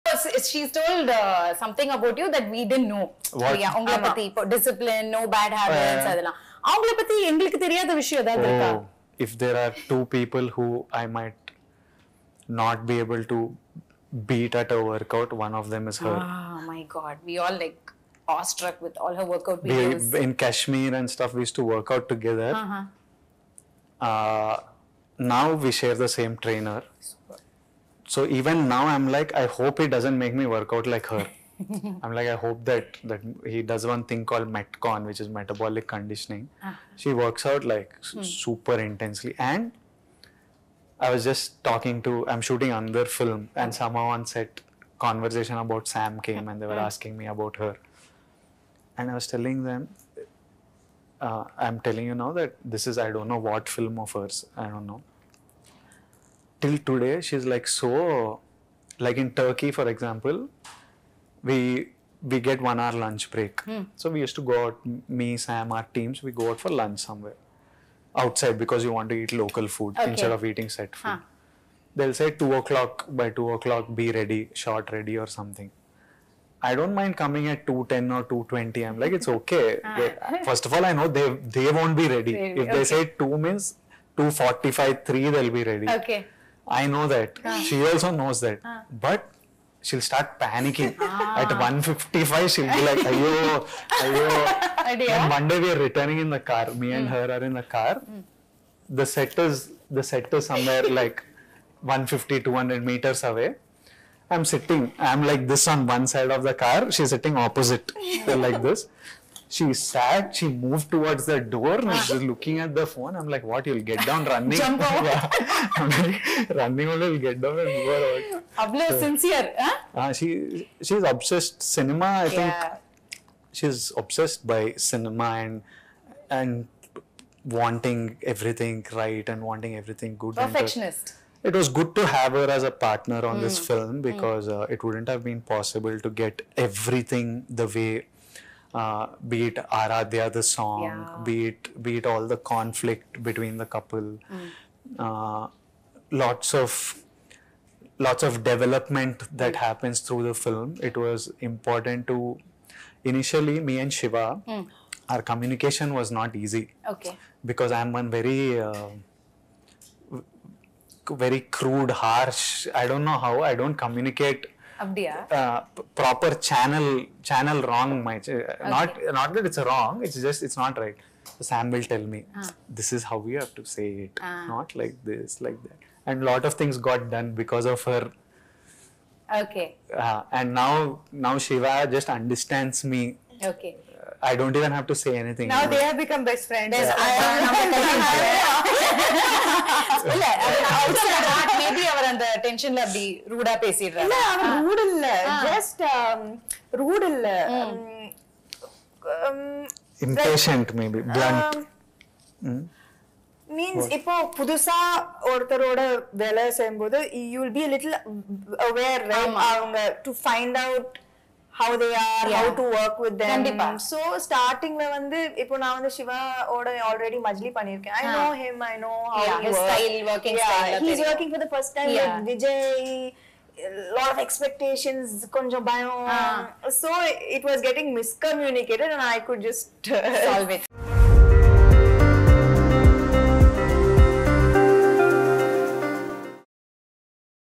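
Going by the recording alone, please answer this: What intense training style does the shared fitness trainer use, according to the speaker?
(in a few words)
metcon.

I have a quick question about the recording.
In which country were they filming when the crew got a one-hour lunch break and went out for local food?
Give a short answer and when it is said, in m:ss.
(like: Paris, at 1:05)
Turkey, at 0:59.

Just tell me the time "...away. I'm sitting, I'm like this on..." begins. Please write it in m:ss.
1:43.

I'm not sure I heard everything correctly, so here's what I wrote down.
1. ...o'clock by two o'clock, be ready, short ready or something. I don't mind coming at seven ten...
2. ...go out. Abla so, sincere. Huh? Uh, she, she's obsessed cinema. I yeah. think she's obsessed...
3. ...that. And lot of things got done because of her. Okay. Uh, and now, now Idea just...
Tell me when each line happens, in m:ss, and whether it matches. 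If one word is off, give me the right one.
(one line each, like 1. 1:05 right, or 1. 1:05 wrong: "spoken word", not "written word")
1. 1:12 wrong: "two", not "seven"
2. 1:57 right
3. 2:55 wrong: "Shiva", not "Idea".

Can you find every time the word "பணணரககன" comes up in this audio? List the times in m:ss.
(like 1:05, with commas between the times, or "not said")
3:37.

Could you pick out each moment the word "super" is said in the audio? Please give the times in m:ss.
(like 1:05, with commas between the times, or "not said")
0:27, 0:38.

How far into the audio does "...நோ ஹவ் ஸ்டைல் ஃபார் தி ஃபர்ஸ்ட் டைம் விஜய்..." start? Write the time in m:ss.
3:38.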